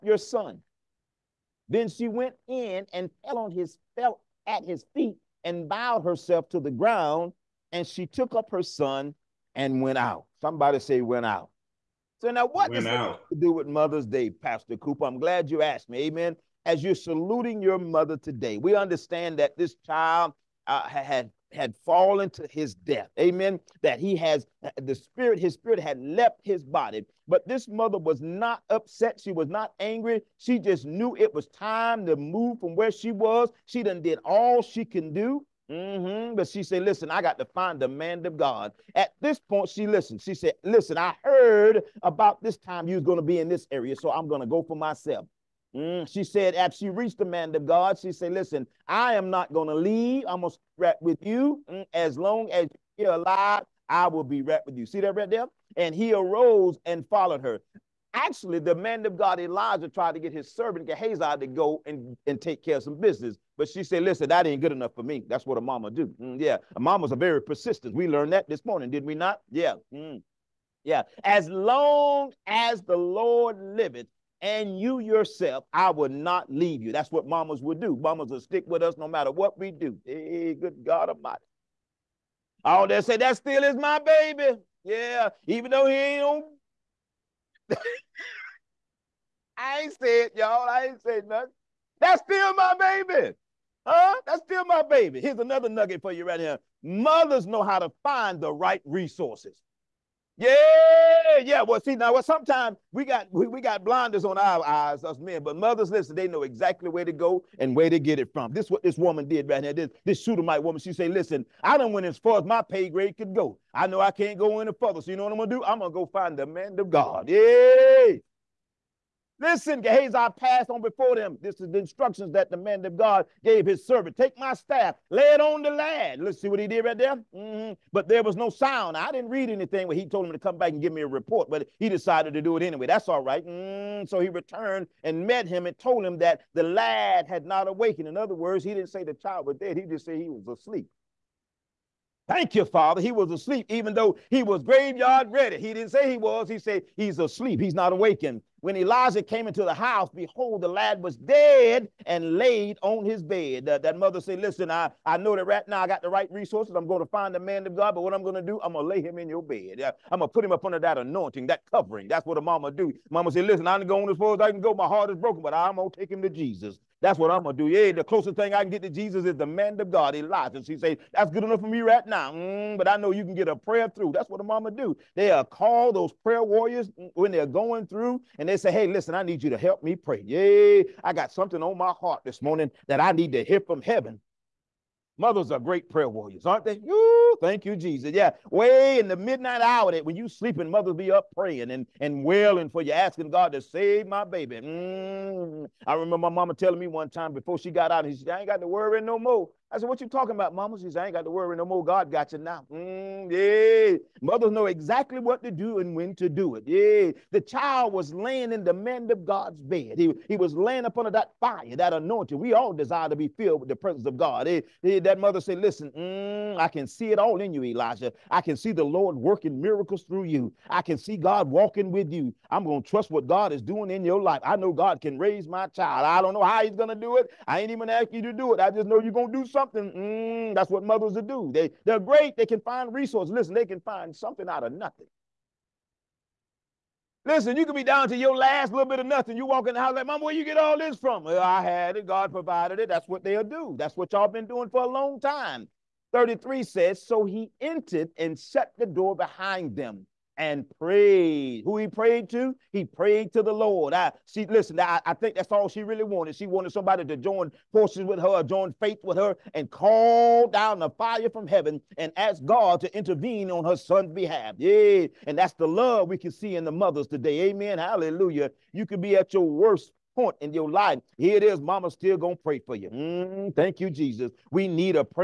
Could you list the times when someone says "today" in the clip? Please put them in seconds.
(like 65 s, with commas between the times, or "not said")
18 s, 267 s.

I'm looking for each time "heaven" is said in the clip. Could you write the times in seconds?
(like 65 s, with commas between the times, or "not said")
183 s, 261 s.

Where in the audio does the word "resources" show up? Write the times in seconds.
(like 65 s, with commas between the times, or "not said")
98 s, 156 s, 232 s.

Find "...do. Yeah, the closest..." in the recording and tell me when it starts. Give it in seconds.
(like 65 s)
167 s.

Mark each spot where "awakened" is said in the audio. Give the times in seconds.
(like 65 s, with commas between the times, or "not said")
137 s, 147 s.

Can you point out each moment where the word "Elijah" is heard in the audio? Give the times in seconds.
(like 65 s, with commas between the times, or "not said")
59 s, 148 s, 170 s, 217 s.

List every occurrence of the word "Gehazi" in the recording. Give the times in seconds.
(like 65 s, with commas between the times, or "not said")
60 s, 119 s.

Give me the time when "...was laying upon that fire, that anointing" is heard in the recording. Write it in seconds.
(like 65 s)
210 s.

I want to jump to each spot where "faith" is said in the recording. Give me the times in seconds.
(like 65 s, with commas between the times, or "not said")
258 s.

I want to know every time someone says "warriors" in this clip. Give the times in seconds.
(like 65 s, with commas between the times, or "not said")
176 s, 186 s.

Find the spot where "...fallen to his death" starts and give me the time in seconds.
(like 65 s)
21 s.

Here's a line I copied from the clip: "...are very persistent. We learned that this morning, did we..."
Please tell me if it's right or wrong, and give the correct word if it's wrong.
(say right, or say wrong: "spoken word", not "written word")
right.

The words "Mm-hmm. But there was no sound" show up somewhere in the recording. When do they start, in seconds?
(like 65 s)
127 s.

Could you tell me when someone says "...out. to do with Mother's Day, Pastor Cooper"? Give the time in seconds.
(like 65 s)
12 s.